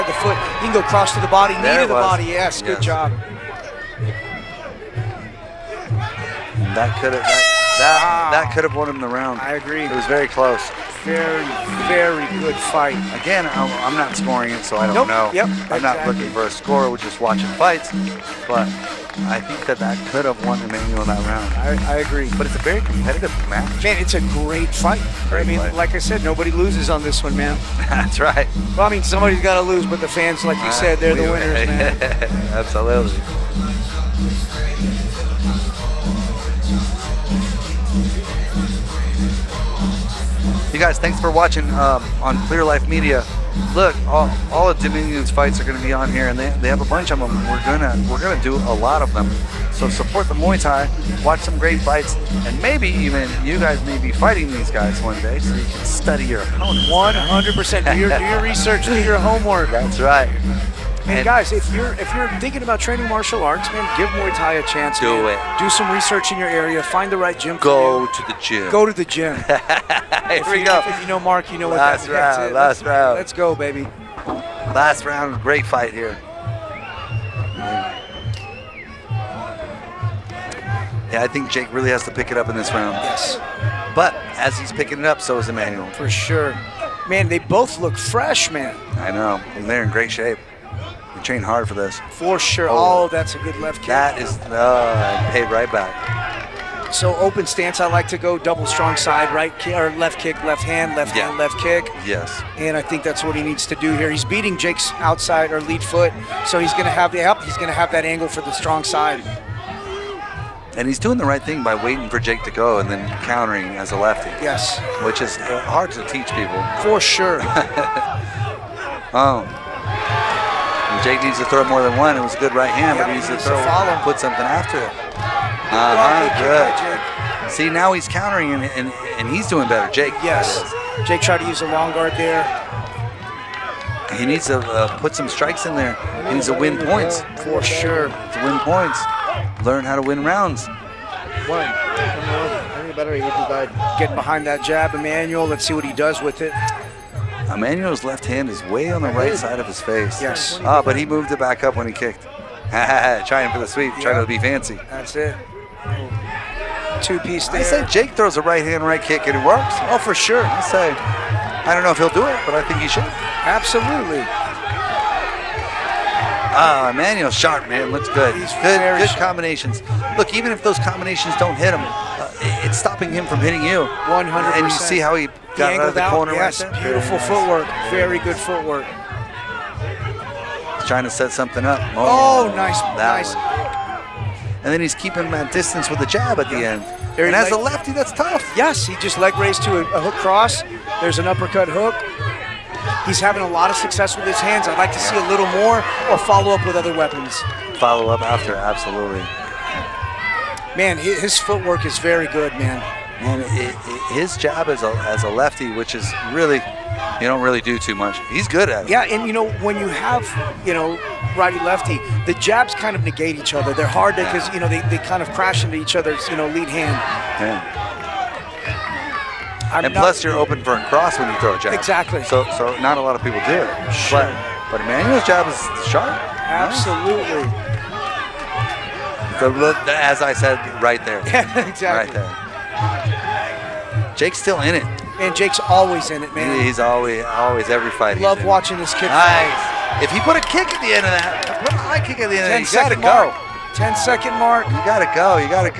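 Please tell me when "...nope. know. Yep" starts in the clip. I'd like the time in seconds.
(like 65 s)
14 s.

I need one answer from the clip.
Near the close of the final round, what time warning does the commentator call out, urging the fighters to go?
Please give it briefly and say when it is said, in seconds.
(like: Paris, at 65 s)
10 second mark, at 243 s.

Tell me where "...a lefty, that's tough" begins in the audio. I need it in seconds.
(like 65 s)
187 s.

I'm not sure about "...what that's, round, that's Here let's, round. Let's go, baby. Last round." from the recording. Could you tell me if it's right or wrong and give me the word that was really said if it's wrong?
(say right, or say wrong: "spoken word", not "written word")
wrong: "Last", not "Here".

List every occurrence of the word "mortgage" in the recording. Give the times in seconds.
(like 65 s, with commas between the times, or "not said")
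not said.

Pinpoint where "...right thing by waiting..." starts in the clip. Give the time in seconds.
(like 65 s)
111 s.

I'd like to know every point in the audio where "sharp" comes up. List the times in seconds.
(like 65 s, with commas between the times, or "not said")
167 s, 225 s.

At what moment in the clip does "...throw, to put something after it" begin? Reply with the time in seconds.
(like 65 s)
123 s.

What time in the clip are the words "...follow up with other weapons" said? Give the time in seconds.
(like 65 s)
196 s.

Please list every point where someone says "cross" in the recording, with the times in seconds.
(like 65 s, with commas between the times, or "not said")
0 s, 190 s, 220 s.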